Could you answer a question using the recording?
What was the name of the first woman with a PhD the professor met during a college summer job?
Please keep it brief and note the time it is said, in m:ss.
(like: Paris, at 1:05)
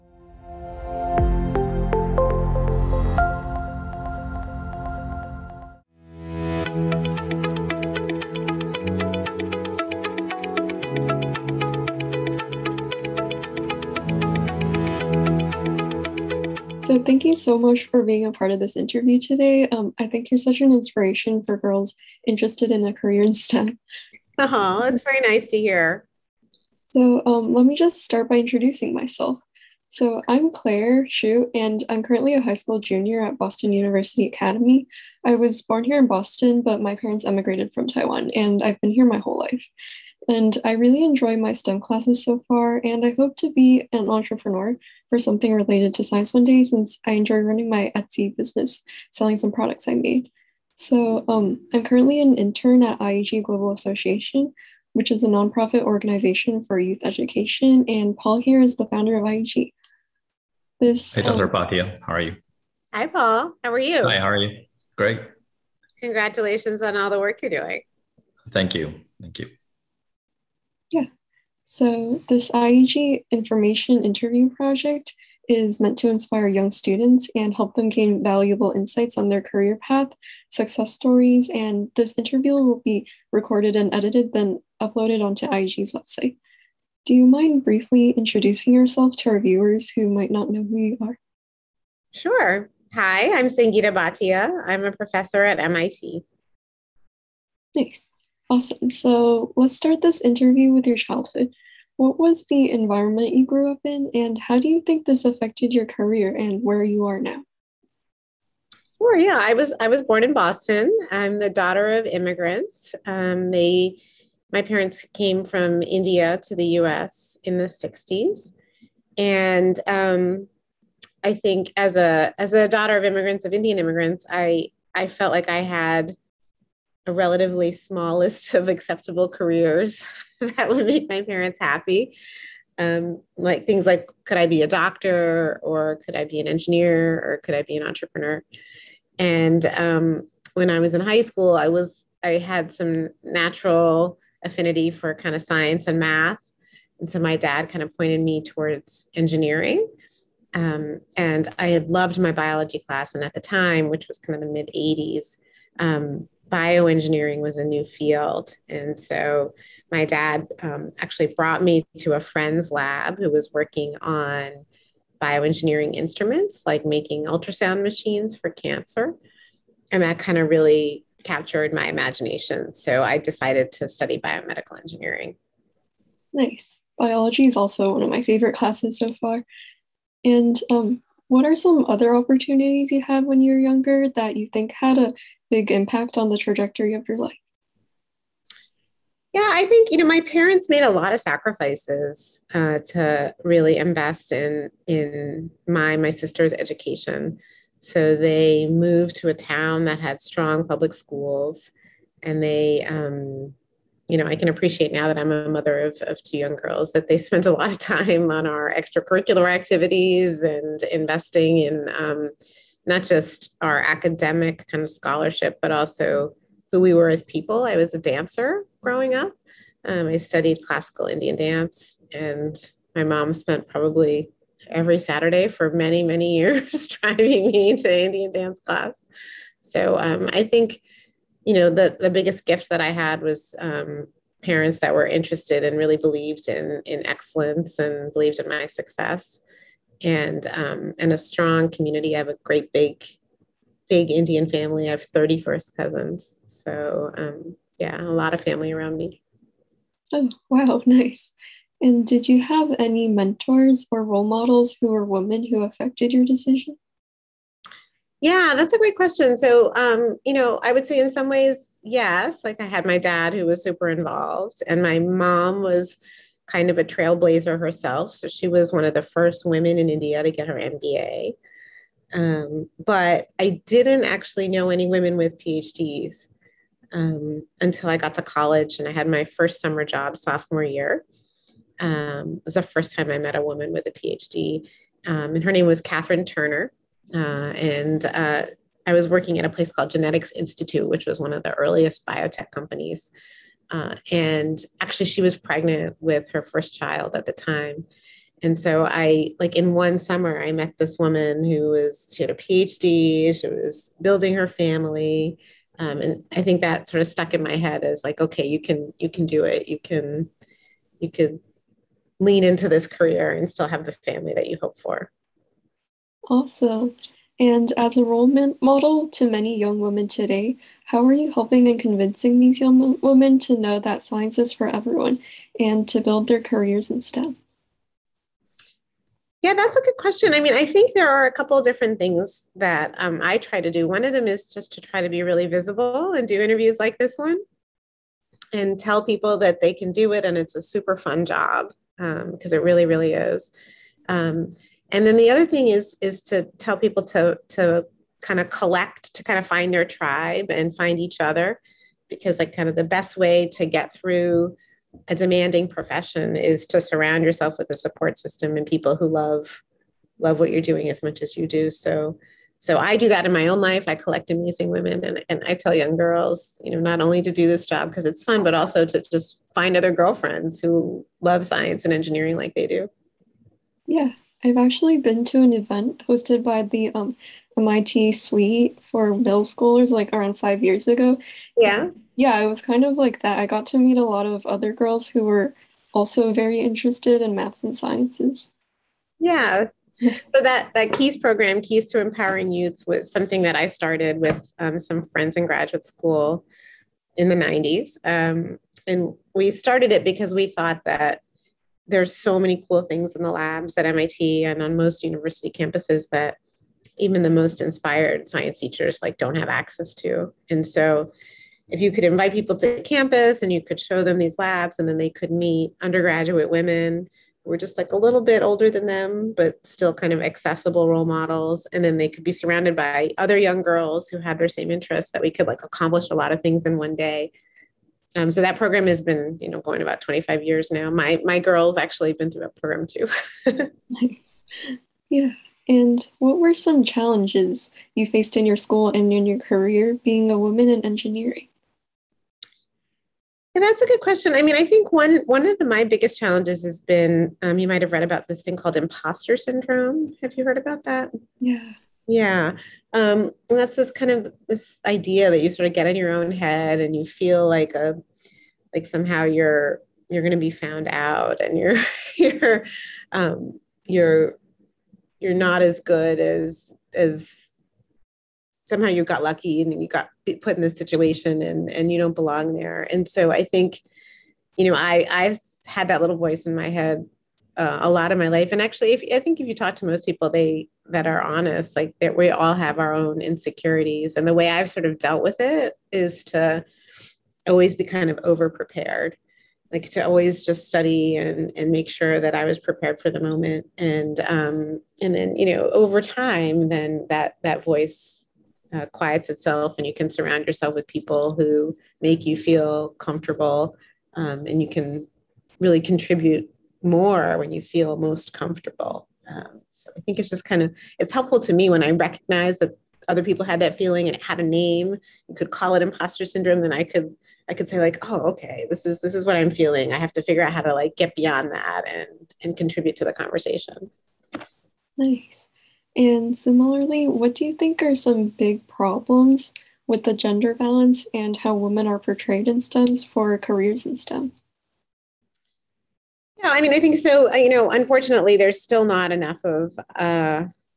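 Catherine Turner, at 4:45.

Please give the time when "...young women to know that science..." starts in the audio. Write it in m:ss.
5:22.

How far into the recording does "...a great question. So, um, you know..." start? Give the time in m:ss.
4:18.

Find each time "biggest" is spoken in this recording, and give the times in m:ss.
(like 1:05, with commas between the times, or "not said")
3:52, 7:25.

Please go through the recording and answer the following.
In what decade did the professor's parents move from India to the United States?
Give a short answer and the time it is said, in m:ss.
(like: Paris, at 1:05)
1960s, at 1:57.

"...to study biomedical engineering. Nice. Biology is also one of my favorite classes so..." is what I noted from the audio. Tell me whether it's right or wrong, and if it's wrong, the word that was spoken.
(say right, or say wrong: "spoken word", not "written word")
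right.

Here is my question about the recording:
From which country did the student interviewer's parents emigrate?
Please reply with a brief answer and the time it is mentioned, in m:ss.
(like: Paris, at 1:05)
Taiwan, at 0:37.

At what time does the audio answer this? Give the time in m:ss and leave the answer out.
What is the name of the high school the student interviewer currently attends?
0:33.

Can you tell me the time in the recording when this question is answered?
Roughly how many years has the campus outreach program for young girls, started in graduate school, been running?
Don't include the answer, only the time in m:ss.
7:09.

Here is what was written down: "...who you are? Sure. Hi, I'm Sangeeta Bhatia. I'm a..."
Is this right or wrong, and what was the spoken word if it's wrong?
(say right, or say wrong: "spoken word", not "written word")
right.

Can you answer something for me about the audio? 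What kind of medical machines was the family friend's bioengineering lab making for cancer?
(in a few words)
ultrasound machines.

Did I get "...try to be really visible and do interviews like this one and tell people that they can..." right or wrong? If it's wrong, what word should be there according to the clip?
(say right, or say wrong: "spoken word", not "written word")
right.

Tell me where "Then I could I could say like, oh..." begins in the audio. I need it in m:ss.
8:36.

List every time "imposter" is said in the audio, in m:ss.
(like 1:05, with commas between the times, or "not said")
7:28, 8:35.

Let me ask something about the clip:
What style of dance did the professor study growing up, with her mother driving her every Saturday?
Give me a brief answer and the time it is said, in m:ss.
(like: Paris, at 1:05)
classical Indian dance, at 3:40.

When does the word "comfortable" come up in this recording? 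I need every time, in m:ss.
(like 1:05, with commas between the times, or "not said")
8:22, 8:28.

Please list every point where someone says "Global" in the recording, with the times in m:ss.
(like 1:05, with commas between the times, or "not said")
0:53.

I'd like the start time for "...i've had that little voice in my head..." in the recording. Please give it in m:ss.
7:55.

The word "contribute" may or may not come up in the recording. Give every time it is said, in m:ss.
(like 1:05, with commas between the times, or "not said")
8:25, 8:42.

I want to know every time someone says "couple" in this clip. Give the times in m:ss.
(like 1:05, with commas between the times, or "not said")
5:31.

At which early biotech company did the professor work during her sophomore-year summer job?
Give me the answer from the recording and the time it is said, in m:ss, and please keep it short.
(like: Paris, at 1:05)
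Genetics Institute, at 4:49.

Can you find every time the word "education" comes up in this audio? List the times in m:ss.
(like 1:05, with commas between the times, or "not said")
0:57, 3:16.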